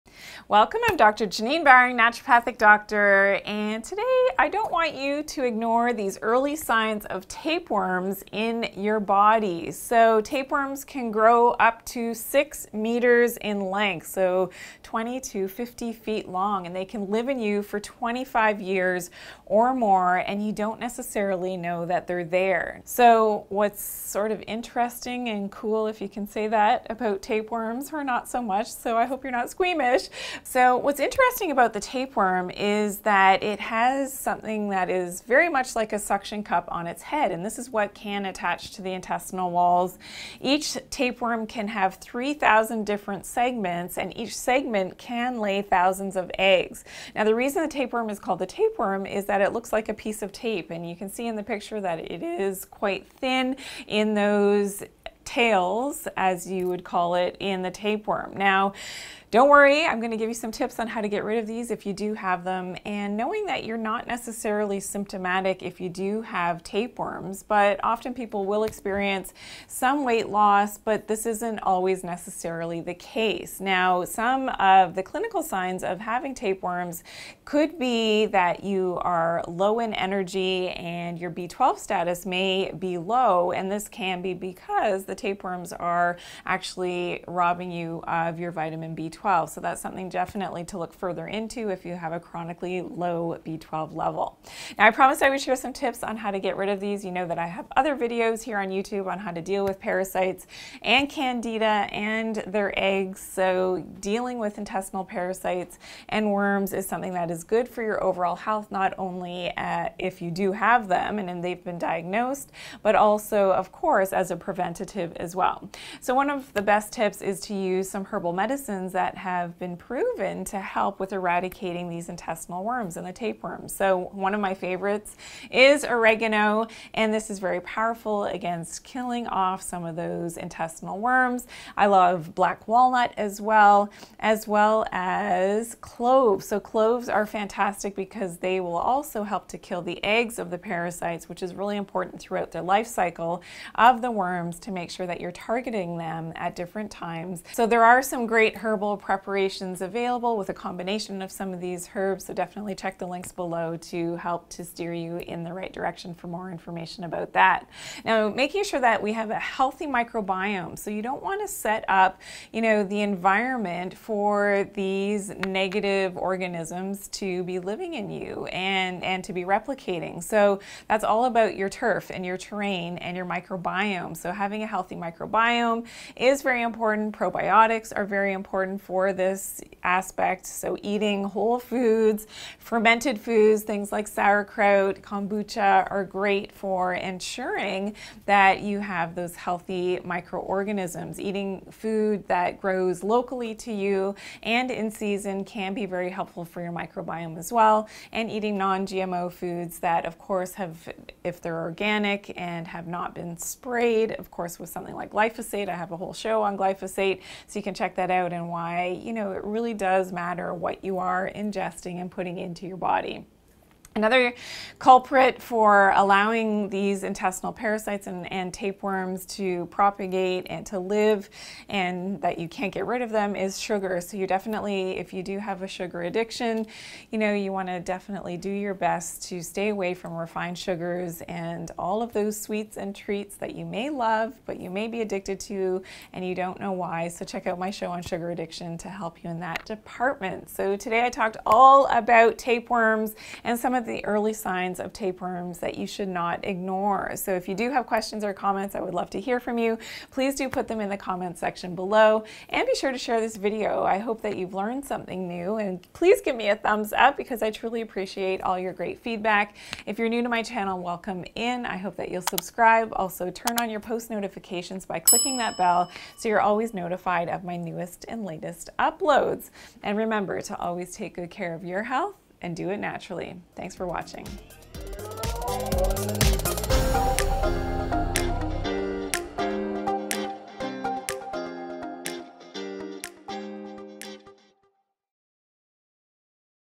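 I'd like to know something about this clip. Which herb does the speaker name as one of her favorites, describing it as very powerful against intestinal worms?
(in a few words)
Oregano.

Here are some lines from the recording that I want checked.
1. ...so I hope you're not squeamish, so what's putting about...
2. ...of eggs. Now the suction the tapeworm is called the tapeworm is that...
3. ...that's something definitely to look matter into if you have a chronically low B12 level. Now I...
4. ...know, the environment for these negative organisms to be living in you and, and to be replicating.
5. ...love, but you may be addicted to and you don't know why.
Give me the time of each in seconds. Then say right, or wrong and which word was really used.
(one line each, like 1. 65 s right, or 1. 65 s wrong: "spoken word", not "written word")
1. 28 s wrong: "interesting", not "putting"
2. 46 s wrong: "reason", not "suction"
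3. 89 s wrong: "further", not "matter"
4. 162 s right
5. 233 s right.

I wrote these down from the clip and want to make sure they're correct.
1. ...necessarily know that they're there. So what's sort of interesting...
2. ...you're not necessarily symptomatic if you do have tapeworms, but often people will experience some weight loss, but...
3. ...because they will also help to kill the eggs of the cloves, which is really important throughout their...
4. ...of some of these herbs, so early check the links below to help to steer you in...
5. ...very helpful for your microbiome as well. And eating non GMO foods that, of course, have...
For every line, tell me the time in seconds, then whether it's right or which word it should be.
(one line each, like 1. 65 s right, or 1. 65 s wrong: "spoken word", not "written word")
1. 20 s right
2. 63 s right
3. 137 s wrong: "parasites", not "cloves"
4. 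151 s wrong: "definitely", not "early"
5. 195 s right.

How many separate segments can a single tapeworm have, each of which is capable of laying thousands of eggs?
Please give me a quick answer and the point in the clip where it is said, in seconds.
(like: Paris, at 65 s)
3,000, at 41 s.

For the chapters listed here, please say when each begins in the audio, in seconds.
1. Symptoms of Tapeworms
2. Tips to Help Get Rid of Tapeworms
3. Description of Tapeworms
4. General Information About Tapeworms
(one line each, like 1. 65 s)
1. 68 s
2. 115 s
3. 32 s
4. 10 s.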